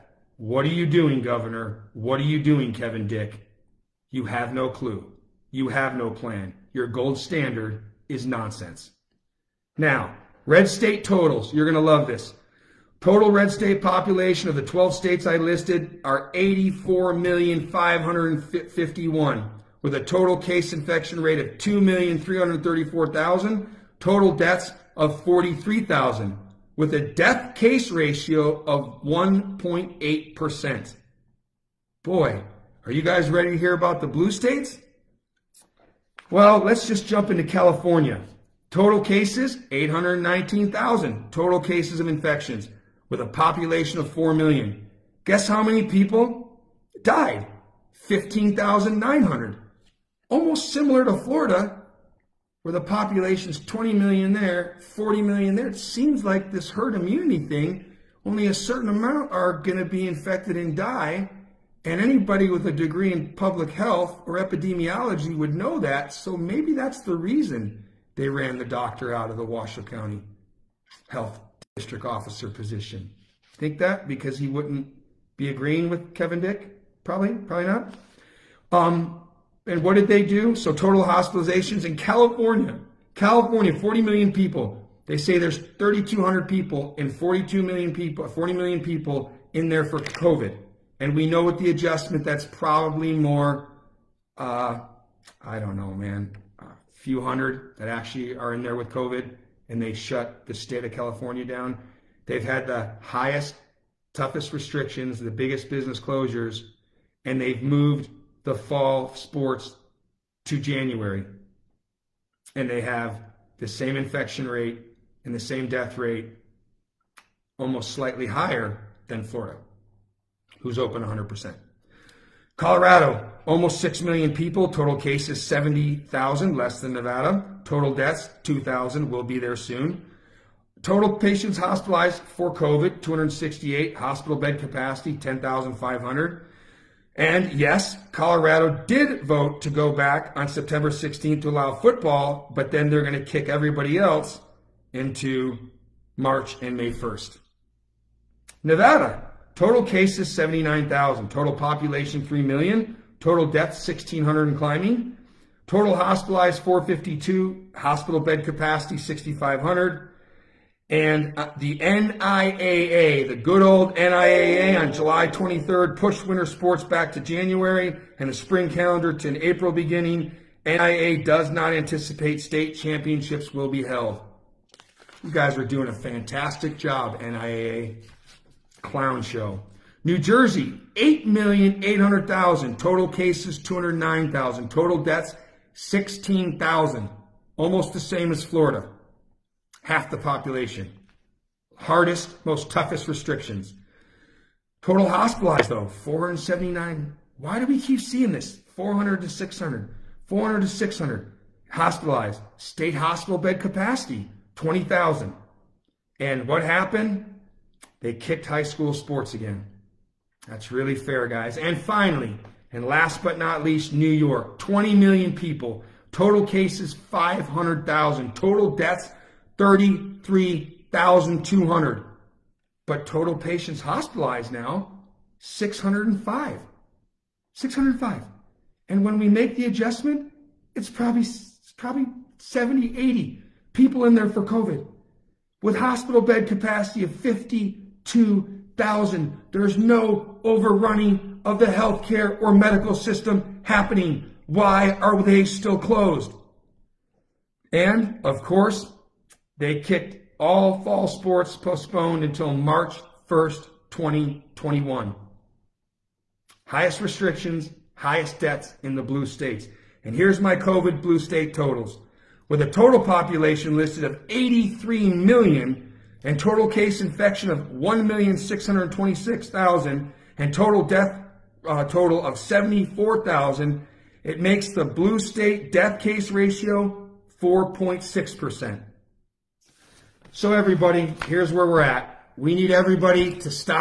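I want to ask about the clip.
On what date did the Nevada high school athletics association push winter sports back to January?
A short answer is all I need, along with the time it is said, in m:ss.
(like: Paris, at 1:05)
July 23rd, at 2:44.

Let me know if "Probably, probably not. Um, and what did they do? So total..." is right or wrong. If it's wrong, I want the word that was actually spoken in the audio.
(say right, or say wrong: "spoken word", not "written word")
right.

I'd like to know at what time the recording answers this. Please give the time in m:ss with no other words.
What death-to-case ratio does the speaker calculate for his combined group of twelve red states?
0:29.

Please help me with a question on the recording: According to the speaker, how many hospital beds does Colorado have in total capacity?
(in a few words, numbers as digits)
10,500.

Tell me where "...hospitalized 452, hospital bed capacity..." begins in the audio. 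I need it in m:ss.
2:35.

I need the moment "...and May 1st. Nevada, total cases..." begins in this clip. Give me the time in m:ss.
2:26.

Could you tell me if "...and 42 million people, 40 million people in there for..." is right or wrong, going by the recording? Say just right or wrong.
right.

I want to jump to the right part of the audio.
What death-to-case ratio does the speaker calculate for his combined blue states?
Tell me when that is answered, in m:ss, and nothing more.
4:37.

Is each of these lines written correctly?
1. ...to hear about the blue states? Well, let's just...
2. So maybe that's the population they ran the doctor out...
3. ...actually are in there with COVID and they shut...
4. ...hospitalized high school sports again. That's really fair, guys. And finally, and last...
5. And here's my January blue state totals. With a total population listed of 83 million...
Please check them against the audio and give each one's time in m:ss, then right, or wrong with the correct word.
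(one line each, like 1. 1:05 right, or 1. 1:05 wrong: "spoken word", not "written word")
1. 0:33 right
2. 1:06 wrong: "reason", not "population"
3. 1:37 right
4. 3:28 wrong: "kicked", not "hospitalized"
5. 4:20 wrong: "COVID", not "January".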